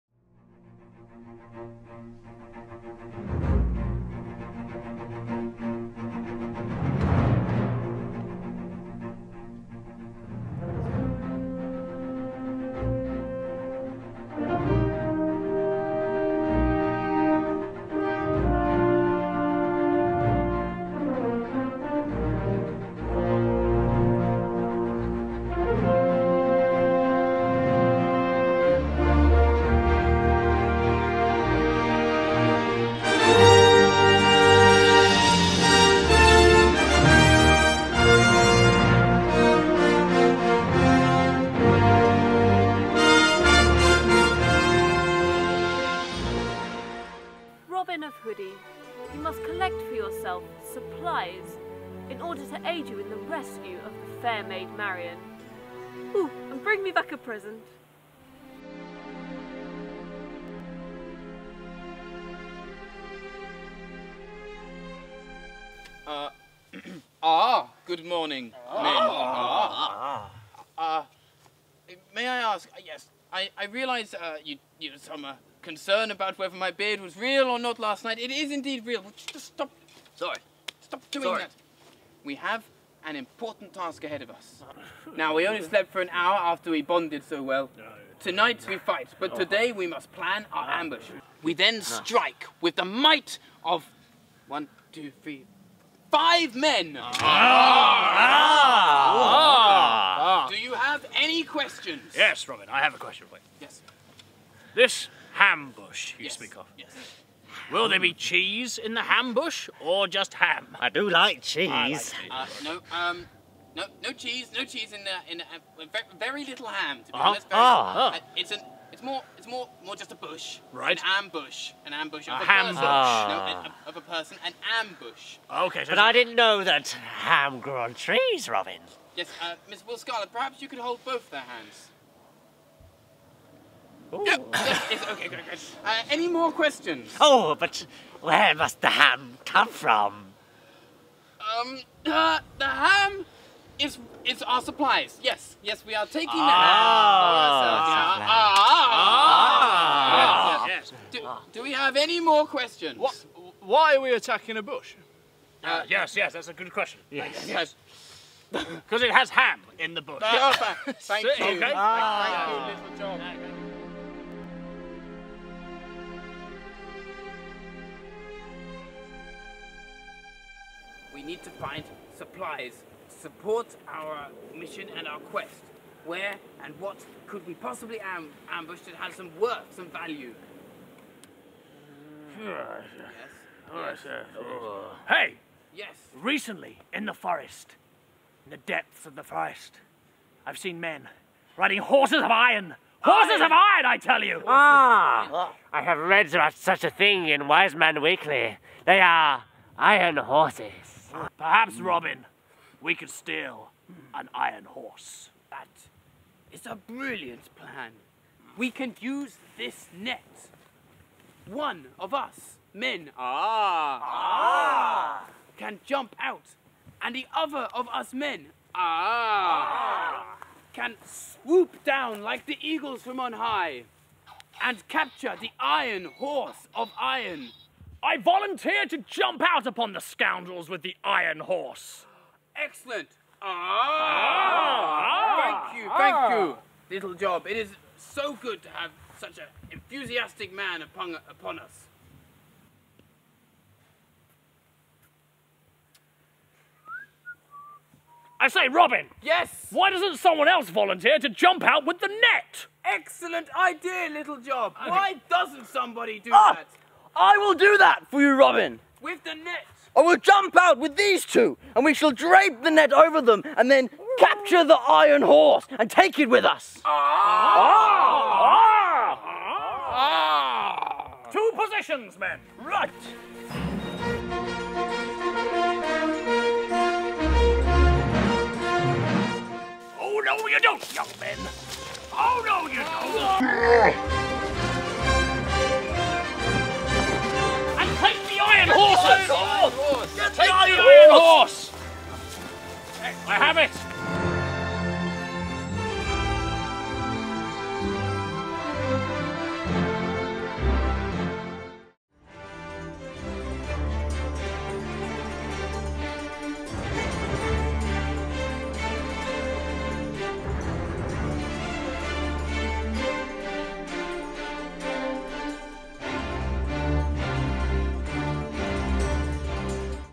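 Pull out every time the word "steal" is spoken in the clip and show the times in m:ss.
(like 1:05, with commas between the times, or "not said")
3:23.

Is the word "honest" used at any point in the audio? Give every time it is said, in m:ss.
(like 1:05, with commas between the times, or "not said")
1:57.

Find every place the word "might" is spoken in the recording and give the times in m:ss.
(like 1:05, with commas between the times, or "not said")
1:32.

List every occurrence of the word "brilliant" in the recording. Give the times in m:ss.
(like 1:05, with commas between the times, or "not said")
3:26.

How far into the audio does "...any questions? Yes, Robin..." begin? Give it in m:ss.
1:41.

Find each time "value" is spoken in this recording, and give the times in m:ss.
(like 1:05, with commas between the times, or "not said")
2:59.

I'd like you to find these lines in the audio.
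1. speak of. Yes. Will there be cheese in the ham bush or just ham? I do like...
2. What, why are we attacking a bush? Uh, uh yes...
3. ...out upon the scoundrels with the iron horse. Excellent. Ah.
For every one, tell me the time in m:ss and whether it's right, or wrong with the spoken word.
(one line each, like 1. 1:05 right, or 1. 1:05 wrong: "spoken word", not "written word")
1. 1:46 right
2. 2:32 right
3. 3:49 right.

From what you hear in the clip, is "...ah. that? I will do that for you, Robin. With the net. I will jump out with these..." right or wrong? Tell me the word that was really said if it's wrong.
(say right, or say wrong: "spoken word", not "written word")
right.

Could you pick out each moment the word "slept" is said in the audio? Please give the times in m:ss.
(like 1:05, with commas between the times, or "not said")
1:25.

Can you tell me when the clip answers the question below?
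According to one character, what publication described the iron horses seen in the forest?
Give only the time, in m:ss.
3:17.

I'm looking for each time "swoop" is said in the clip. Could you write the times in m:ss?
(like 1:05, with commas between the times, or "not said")
3:41.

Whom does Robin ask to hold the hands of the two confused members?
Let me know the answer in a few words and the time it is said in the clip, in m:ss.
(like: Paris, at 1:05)
Will Scarlet, at 2:09.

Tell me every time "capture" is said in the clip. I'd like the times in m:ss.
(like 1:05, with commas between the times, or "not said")
3:44, 4:24.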